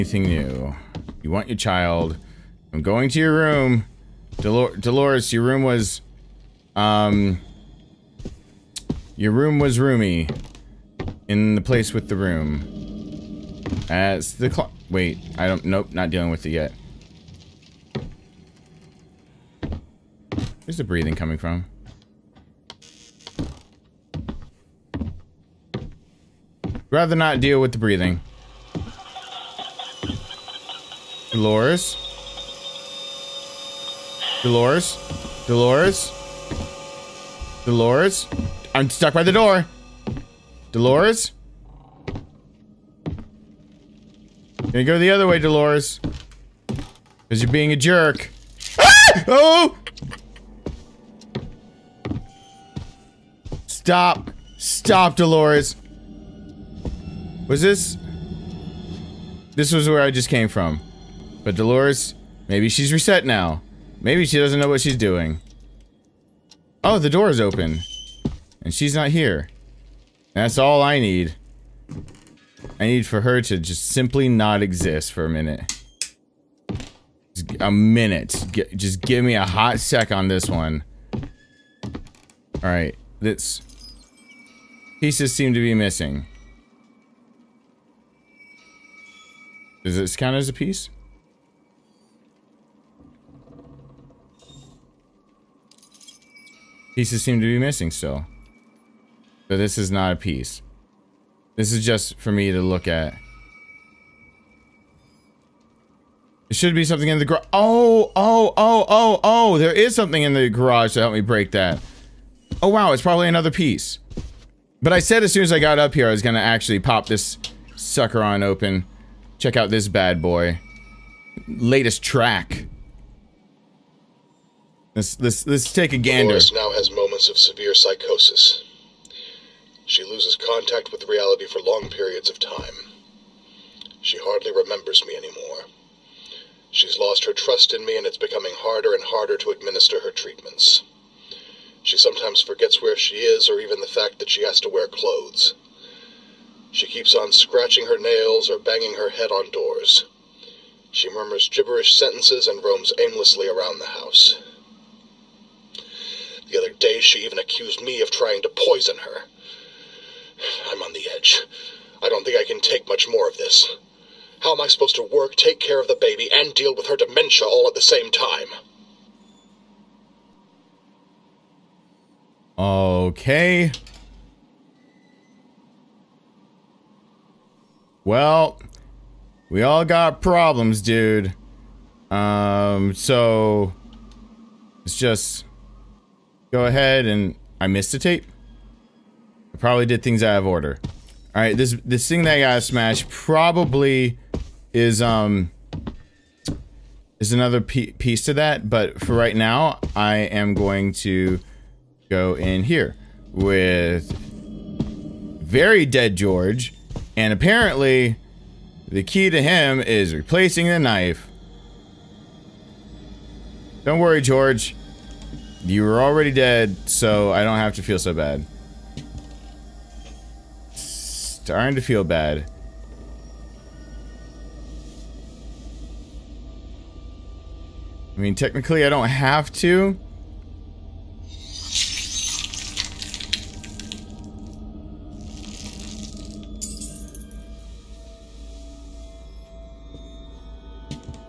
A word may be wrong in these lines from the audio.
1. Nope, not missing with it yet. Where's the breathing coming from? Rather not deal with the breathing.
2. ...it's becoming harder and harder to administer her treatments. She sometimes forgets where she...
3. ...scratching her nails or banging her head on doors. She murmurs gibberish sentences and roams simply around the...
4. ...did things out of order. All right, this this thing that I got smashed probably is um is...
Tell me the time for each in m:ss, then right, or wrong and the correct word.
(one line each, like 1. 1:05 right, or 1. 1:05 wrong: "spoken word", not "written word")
1. 0:15 wrong: "dealing", not "missing"
2. 2:18 right
3. 2:27 wrong: "aimlessly", not "simply"
4. 3:09 right.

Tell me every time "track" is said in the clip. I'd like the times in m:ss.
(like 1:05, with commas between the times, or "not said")
2:02.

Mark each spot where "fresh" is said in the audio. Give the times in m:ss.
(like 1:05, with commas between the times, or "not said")
not said.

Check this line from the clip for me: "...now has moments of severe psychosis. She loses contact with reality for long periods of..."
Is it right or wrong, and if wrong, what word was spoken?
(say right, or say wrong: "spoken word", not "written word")
right.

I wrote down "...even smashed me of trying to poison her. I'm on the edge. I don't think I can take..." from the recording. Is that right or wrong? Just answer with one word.
wrong.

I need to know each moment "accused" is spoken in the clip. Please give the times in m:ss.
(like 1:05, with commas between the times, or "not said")
2:37.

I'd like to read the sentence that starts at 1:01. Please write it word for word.
But Dolores, maybe she's reset now.